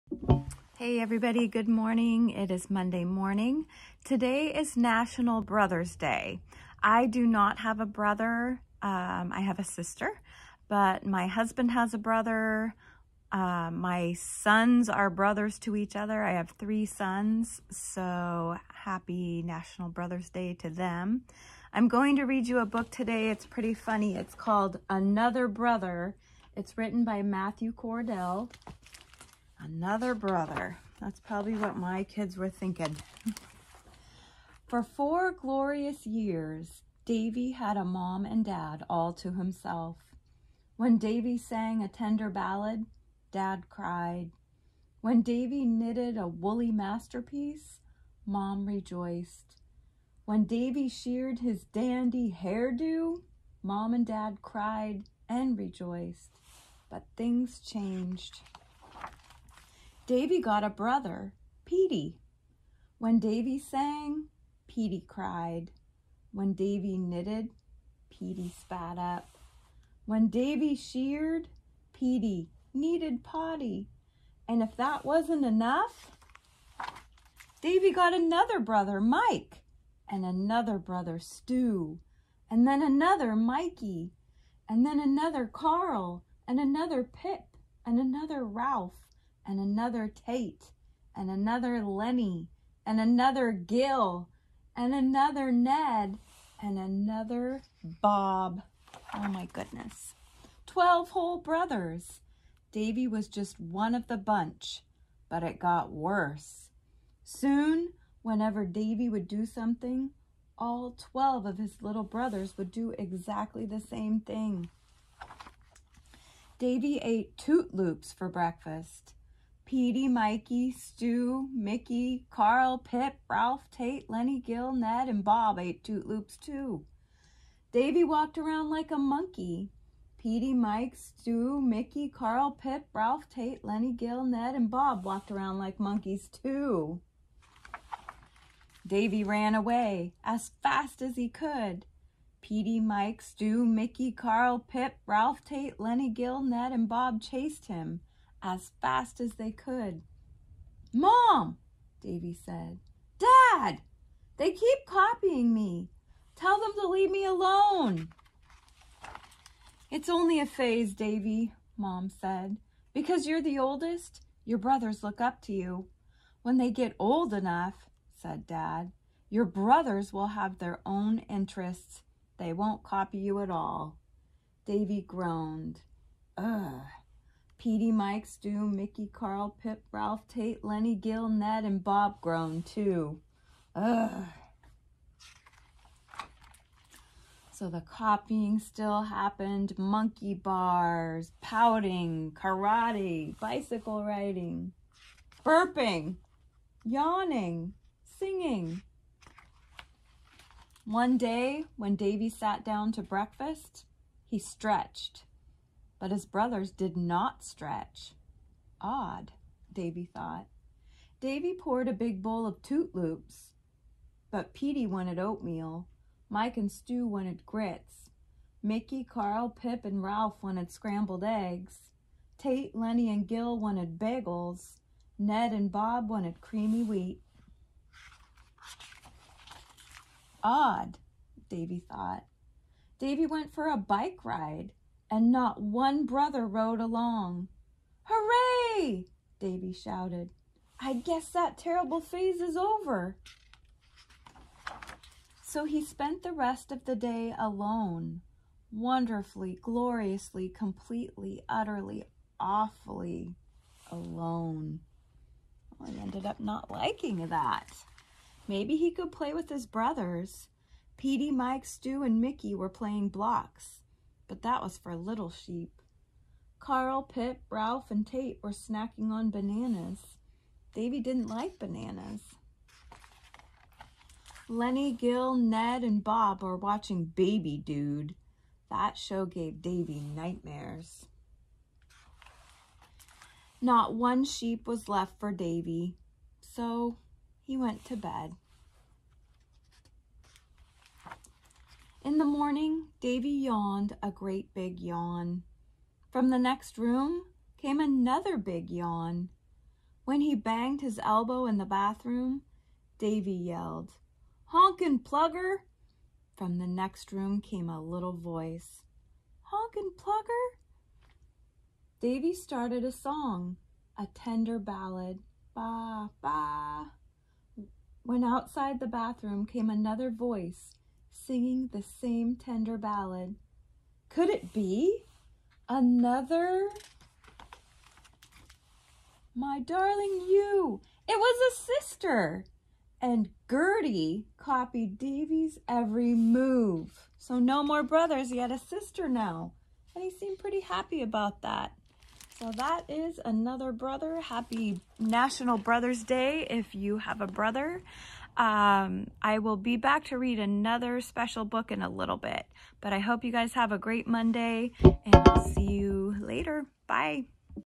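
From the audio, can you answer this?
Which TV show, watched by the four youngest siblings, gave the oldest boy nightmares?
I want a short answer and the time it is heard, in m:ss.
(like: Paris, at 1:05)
Baby Dude, at 4:37.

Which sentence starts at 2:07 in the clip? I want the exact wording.
Davy walked around like a monkey.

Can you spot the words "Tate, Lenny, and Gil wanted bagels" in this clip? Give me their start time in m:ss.
3:42.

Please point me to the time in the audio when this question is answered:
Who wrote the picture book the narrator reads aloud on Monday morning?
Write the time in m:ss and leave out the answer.
0:27.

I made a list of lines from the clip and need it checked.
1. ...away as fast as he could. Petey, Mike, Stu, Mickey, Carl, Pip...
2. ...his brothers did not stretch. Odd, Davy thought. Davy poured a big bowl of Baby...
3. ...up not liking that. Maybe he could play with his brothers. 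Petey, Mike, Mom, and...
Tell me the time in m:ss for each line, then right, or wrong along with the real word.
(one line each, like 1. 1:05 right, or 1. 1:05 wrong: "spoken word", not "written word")
1. 2:19 right
2. 3:26 wrong: "Toot", not "Baby"
3. 4:16 wrong: "Stu", not "Mom".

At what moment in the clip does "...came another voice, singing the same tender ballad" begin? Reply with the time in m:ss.
5:19.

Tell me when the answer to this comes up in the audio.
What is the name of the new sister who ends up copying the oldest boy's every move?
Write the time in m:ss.
5:33.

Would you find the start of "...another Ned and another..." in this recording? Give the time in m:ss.
1:34.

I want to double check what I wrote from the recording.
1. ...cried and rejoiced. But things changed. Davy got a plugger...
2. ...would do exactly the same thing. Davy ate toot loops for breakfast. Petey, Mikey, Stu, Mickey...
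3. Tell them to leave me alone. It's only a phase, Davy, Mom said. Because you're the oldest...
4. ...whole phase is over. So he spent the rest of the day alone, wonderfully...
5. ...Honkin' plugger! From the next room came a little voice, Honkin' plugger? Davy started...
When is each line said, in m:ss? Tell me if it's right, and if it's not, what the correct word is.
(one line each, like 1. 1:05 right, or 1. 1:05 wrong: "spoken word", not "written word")
1. 0:54 wrong: "brother", not "plugger"
2. 1:52 right
3. 2:36 right
4. 4:01 wrong: "terrible", not "whole"
5. 5:04 right.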